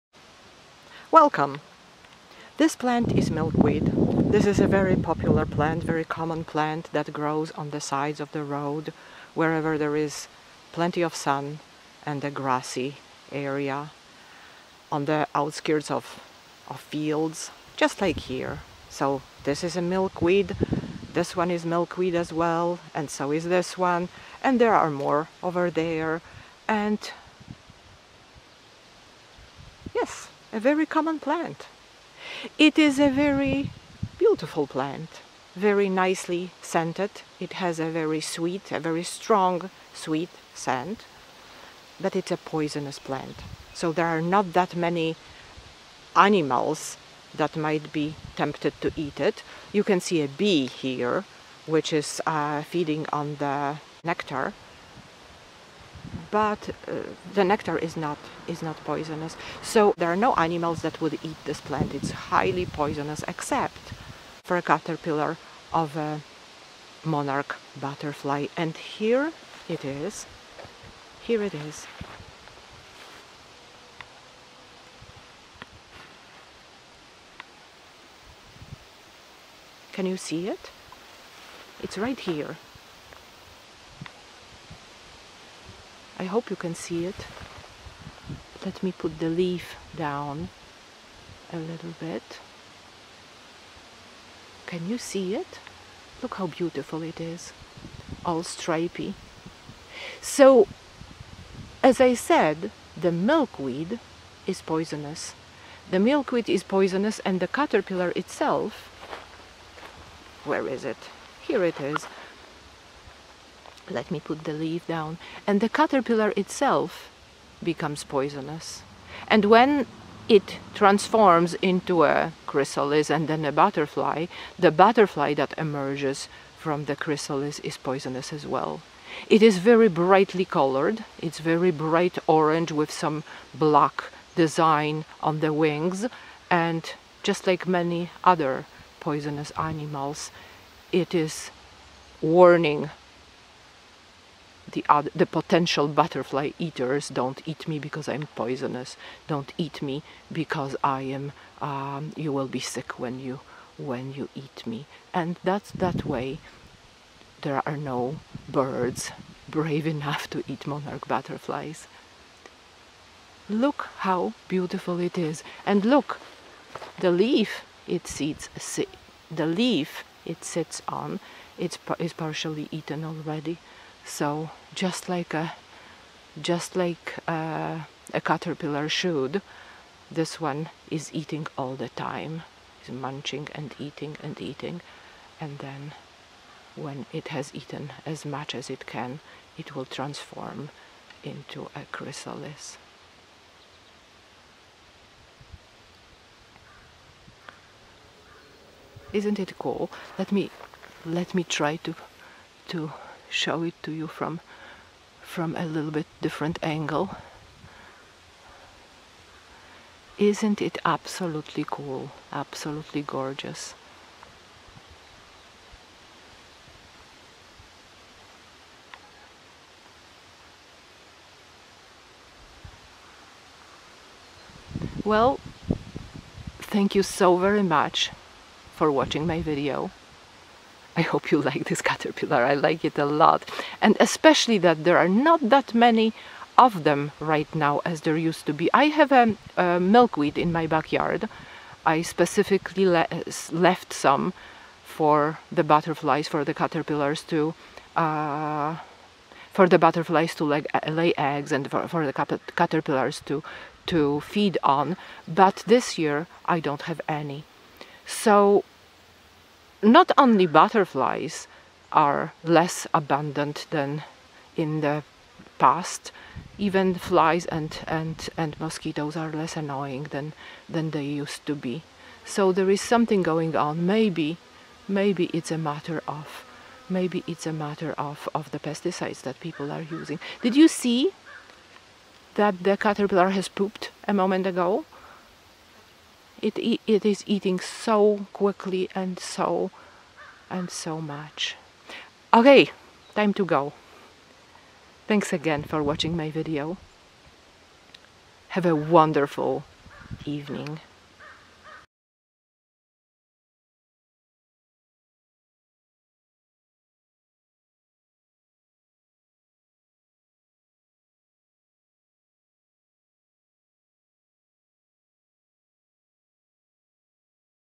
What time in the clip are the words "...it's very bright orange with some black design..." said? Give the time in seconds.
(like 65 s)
131 s.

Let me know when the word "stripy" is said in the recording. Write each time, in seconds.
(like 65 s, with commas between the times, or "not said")
98 s.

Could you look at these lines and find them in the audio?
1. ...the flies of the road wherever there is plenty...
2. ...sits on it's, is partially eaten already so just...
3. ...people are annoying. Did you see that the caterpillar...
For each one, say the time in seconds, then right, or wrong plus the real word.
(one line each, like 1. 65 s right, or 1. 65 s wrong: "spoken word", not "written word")
1. 7 s wrong: "sides", not "flies"
2. 170 s right
3. 279 s wrong: "using", not "annoying".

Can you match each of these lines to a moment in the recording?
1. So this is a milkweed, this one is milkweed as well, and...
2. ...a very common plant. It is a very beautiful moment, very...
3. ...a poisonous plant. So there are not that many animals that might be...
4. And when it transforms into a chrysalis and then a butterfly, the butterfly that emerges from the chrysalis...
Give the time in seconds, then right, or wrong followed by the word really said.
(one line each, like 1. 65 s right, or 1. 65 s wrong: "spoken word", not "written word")
1. 18 s right
2. 30 s wrong: "plant", not "moment"
3. 42 s right
4. 119 s right.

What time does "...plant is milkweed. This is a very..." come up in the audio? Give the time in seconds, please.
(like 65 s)
2 s.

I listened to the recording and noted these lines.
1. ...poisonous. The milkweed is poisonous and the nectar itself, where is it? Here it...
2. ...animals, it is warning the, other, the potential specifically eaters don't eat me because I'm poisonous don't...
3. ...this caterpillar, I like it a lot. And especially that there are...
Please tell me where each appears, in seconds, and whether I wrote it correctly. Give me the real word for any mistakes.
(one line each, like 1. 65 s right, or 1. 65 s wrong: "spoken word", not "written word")
1. 104 s wrong: "caterpillar", not "nectar"
2. 139 s wrong: "butterfly", not "specifically"
3. 231 s right.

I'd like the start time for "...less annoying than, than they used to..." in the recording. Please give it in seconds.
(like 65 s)
269 s.